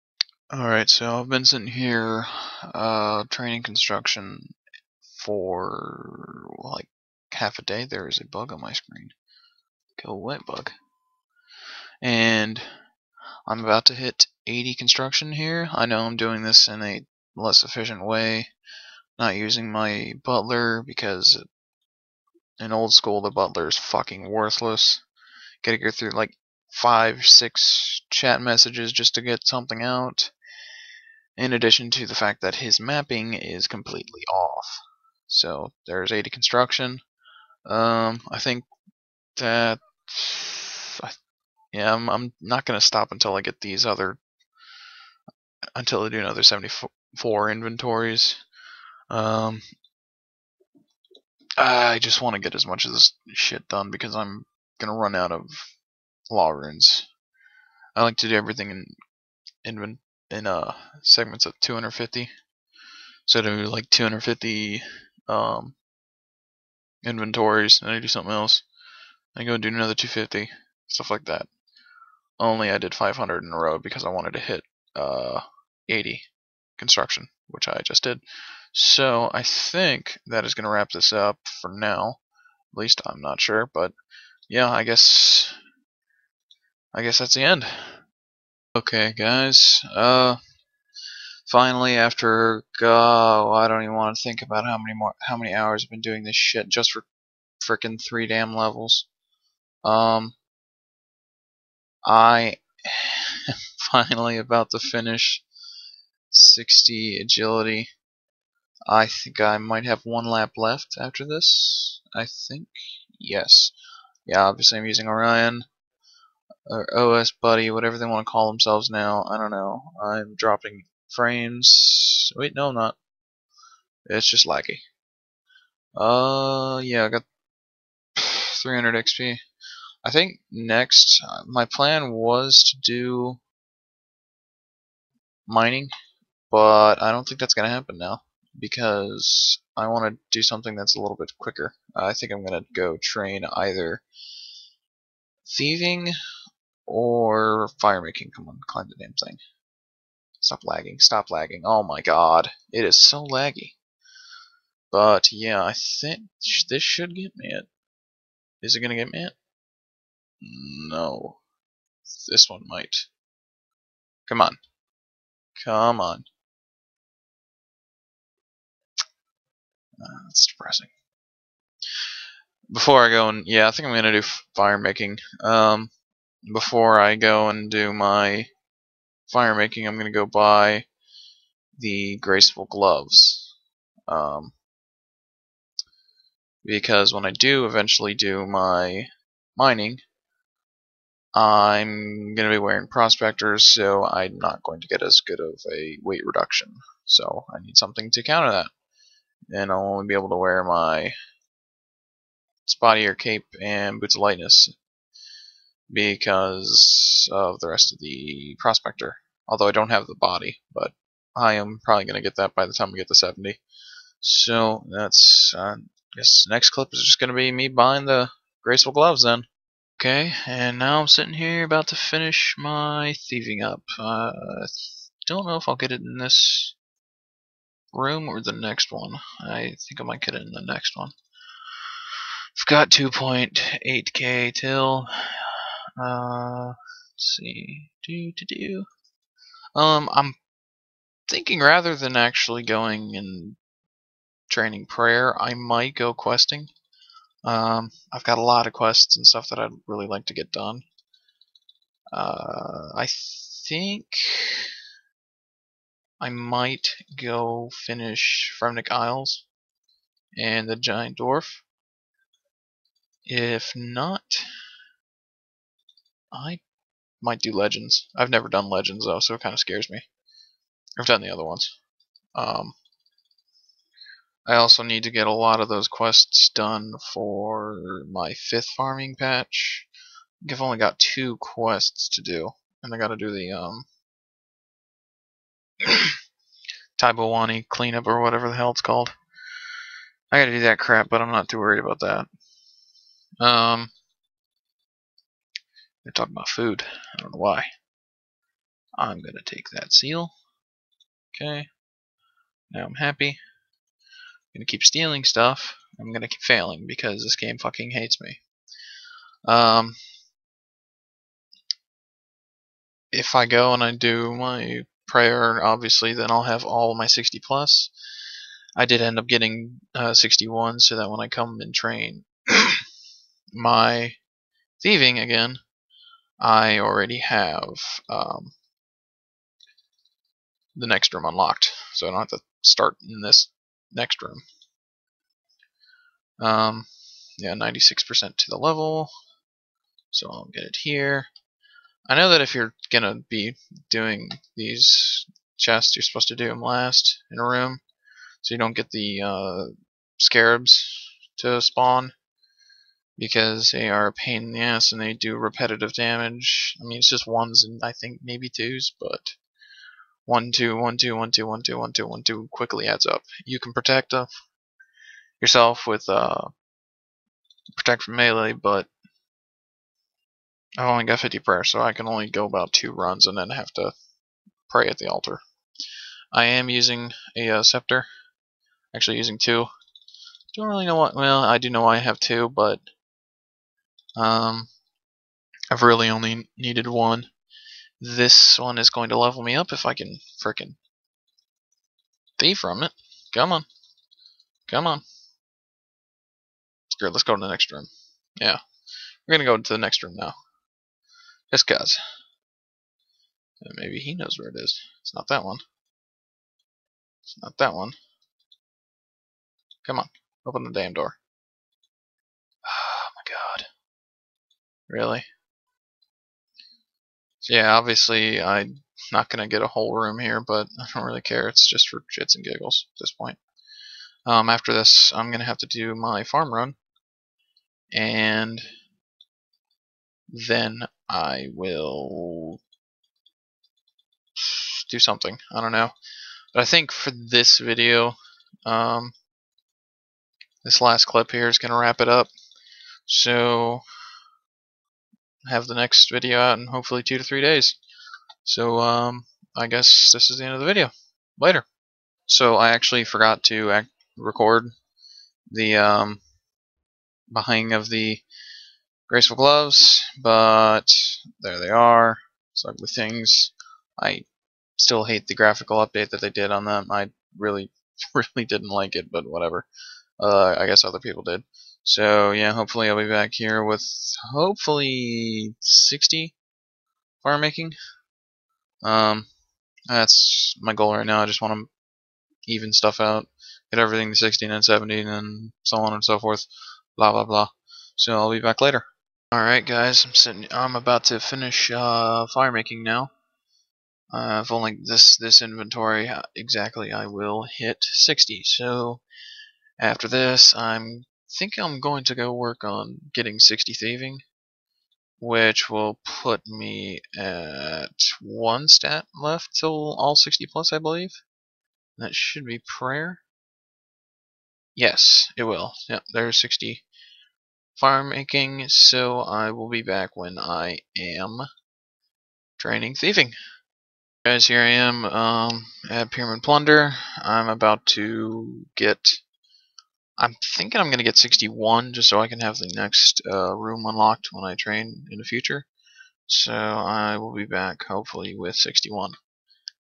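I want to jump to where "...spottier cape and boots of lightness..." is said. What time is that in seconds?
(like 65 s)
202 s.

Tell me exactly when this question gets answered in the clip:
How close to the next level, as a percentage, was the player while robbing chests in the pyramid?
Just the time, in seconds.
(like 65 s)
337 s.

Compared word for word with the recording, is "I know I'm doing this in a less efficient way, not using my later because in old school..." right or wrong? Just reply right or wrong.
wrong.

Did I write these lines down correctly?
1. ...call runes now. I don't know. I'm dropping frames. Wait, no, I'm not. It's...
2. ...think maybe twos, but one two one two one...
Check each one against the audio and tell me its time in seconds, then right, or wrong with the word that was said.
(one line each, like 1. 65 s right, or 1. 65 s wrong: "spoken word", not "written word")
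1. 118 s wrong: "themselves", not "runes"
2. 357 s right.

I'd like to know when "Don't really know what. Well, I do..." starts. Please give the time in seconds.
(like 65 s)
380 s.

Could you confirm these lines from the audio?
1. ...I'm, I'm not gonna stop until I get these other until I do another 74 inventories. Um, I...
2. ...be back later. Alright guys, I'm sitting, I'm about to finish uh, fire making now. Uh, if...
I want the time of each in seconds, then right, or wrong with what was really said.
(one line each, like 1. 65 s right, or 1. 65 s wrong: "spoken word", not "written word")
1. 41 s right
2. 488 s right.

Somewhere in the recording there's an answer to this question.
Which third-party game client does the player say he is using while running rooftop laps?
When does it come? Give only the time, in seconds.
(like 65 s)
115 s.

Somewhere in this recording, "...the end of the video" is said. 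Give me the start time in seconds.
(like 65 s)
450 s.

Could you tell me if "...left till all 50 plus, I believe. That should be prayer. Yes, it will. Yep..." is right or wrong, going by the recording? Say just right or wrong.
wrong.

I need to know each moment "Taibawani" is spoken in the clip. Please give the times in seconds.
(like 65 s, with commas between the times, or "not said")
286 s.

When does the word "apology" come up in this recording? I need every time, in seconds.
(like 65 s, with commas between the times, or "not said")
not said.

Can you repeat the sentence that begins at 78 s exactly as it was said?
So I think that is going to wrap this up for now.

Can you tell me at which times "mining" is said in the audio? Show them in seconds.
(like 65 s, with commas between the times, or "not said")
135 s, 189 s.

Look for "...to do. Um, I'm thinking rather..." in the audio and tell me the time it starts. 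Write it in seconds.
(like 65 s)
238 s.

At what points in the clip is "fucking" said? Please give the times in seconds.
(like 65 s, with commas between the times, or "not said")
23 s, 307 s.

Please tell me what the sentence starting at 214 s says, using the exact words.
So that's, uh, I guess next clip is just going to be me buying the graceful gloves then.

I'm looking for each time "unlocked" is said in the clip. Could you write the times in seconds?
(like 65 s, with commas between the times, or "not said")
331 s, 533 s.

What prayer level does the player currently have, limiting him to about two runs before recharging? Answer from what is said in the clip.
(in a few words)
50.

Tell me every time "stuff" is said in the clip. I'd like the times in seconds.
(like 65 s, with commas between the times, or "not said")
70 s, 249 s, 305 s, 482 s.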